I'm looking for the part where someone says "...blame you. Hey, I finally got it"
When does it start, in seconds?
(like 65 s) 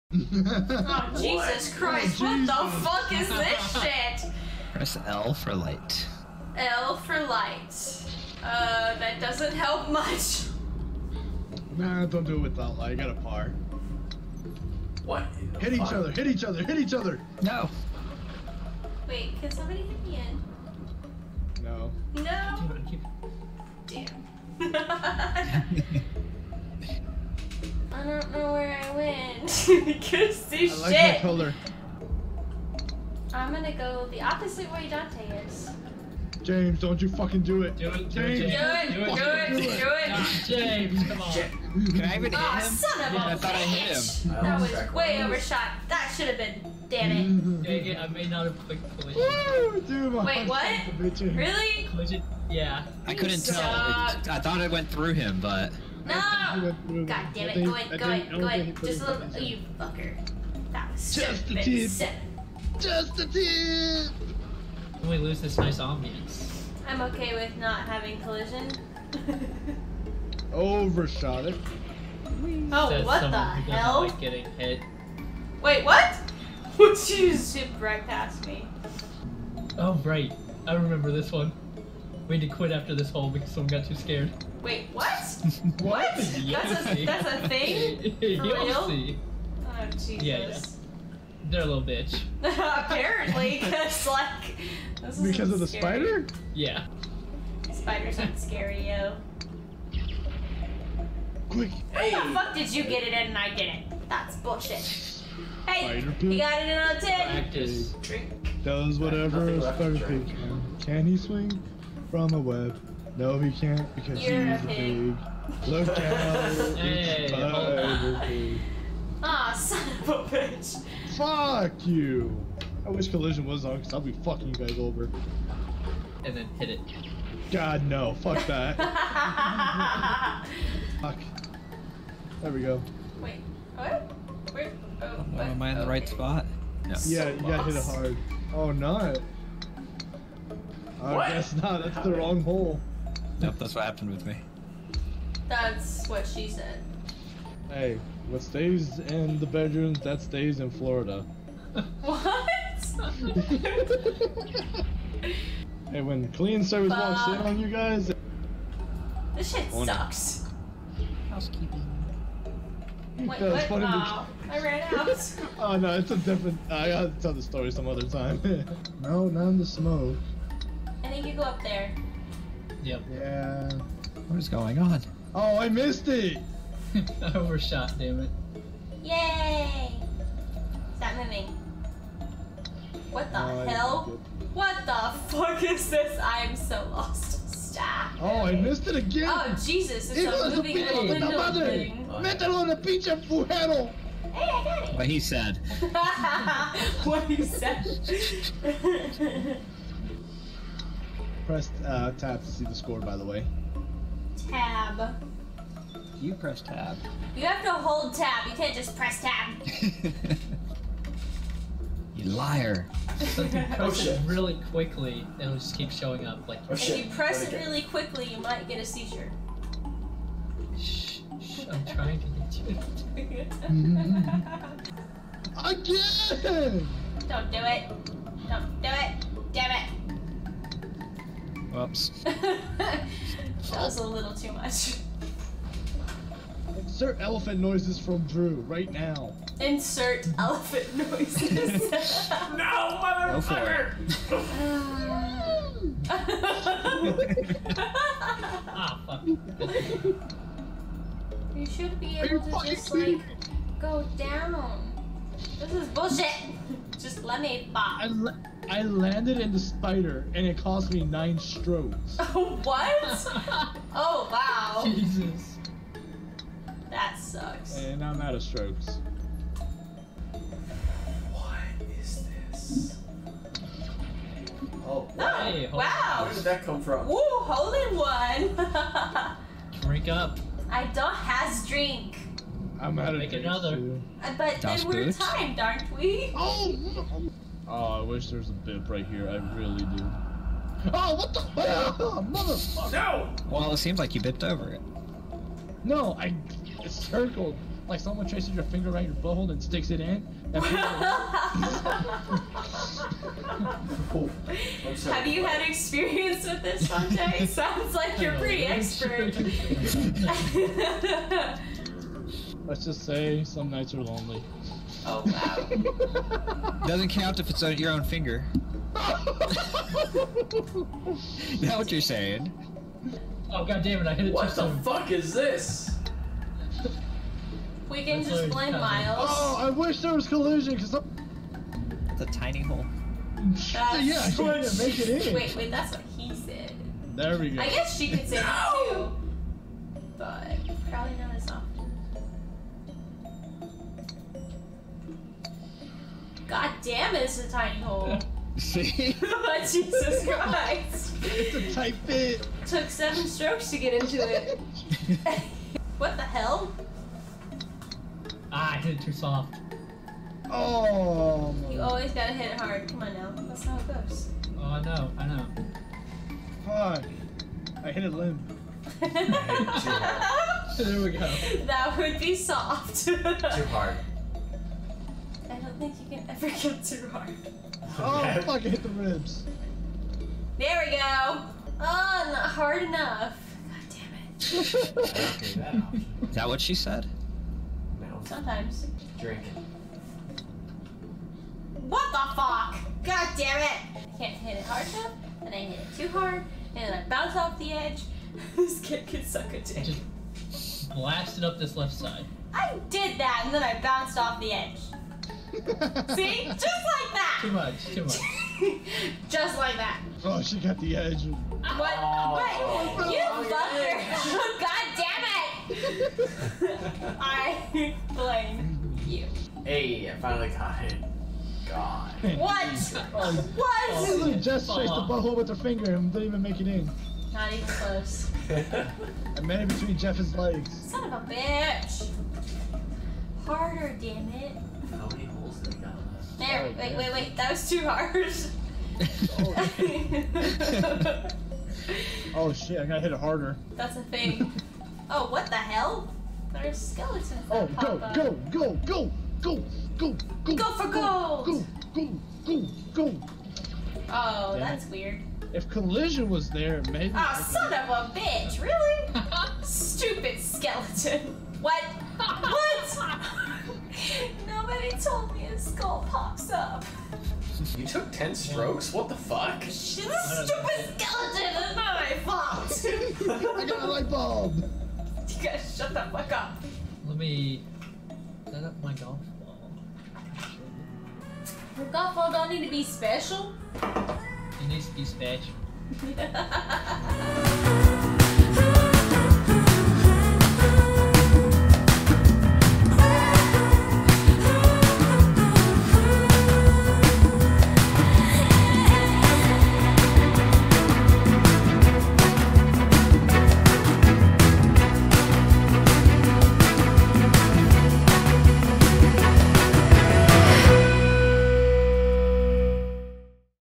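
418 s.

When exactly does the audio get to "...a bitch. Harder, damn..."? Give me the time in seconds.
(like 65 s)
431 s.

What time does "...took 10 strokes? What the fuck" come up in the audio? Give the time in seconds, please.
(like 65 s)
467 s.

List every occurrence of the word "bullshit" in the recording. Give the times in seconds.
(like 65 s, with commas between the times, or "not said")
104 s, 255 s.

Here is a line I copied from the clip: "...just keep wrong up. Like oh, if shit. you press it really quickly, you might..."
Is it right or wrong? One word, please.
wrong.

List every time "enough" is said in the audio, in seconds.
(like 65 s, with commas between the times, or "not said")
382 s, 394 s.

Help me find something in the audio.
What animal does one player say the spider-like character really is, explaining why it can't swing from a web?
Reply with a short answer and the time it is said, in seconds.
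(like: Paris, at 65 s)
A pig, at 114 s.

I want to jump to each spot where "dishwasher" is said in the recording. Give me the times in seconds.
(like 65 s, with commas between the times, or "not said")
not said.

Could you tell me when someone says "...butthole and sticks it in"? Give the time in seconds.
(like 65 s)
299 s.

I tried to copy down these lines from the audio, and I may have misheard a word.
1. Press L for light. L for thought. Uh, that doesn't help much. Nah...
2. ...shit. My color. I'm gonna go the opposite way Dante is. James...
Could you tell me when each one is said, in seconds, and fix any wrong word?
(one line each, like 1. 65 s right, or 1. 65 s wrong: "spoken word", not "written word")
1. 4 s wrong: "light", not "thought"
2. 30 s right.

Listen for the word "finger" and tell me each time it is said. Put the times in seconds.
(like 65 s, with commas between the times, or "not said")
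298 s, 318 s, 425 s.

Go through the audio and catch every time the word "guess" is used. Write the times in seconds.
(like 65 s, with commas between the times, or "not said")
141 s, 337 s.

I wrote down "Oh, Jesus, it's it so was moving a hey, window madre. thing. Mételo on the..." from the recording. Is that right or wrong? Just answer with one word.
right.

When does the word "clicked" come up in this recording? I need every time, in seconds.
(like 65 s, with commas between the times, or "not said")
48 s.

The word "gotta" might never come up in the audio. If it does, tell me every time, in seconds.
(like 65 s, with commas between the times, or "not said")
166 s, 362 s, 442 s.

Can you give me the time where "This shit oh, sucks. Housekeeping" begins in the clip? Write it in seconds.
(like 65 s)
159 s.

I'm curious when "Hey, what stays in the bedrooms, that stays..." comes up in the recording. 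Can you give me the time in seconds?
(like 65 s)
147 s.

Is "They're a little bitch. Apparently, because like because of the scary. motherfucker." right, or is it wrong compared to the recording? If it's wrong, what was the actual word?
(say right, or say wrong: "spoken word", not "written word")
wrong: "spider", not "motherfucker".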